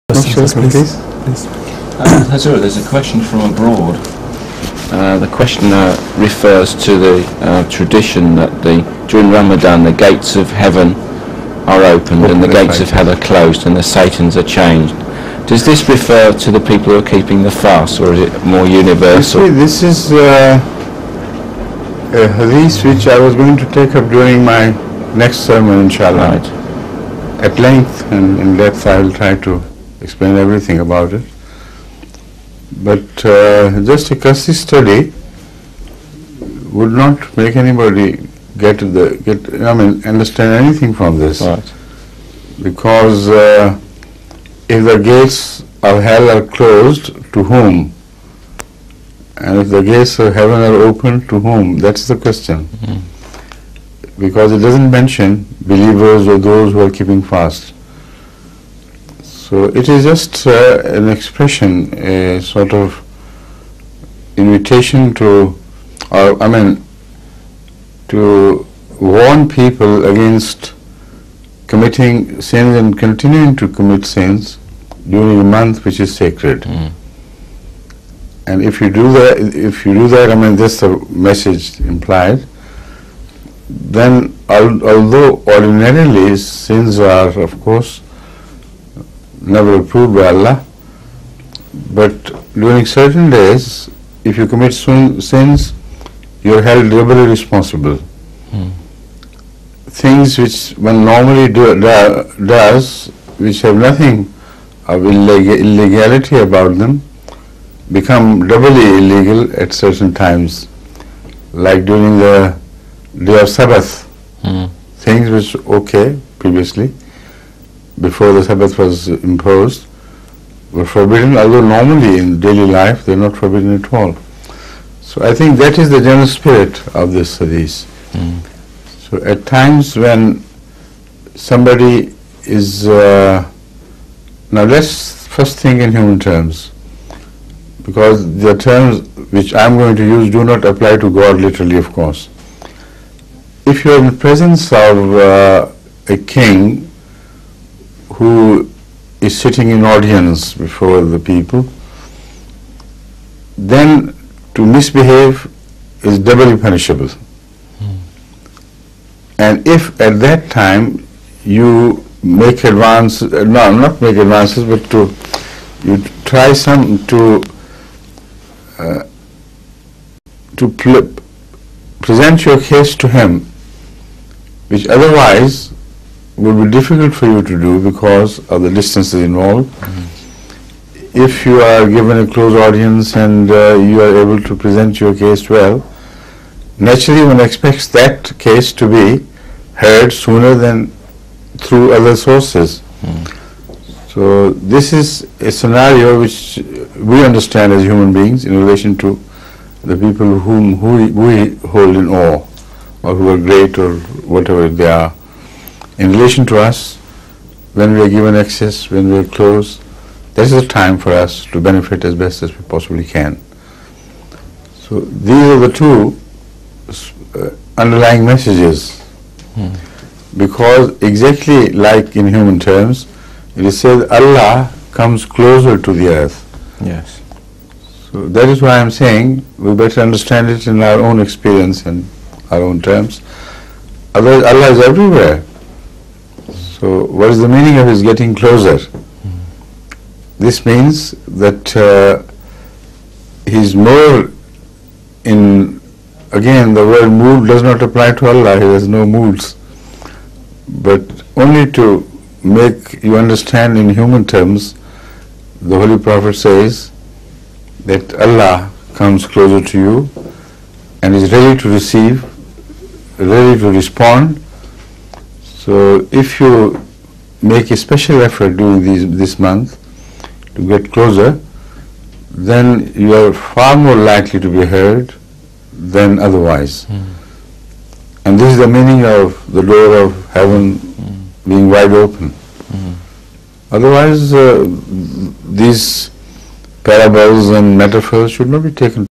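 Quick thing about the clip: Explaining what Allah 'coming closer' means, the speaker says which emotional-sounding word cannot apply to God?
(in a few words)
Mood.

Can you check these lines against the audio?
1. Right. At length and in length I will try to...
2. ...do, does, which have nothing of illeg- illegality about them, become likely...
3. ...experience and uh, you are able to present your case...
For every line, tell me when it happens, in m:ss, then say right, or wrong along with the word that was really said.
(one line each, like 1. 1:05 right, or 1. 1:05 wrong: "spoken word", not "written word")
1. 0:26 wrong: "depth", not "length"
2. 1:41 wrong: "doubly", not "likely"
3. 3:02 wrong: "audience", not "experience".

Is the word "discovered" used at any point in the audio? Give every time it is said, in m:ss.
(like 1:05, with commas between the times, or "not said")
not said.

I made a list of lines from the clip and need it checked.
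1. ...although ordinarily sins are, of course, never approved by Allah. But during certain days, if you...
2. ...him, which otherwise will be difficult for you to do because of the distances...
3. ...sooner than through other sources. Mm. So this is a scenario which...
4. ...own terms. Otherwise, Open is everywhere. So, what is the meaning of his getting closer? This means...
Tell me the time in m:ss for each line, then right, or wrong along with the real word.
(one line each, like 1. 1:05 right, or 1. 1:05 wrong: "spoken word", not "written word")
1. 1:24 right
2. 2:53 right
3. 3:10 right
4. 3:52 wrong: "Allah", not "Open".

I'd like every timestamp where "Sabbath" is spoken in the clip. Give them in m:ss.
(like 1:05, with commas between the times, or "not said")
1:53, 1:58.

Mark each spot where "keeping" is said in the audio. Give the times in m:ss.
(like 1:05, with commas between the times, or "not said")
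0:17, 0:56.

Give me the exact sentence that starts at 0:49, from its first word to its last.
And if the gates of heaven are open, to whom?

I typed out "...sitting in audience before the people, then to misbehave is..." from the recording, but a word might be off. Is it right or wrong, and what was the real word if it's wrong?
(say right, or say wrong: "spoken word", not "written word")
right.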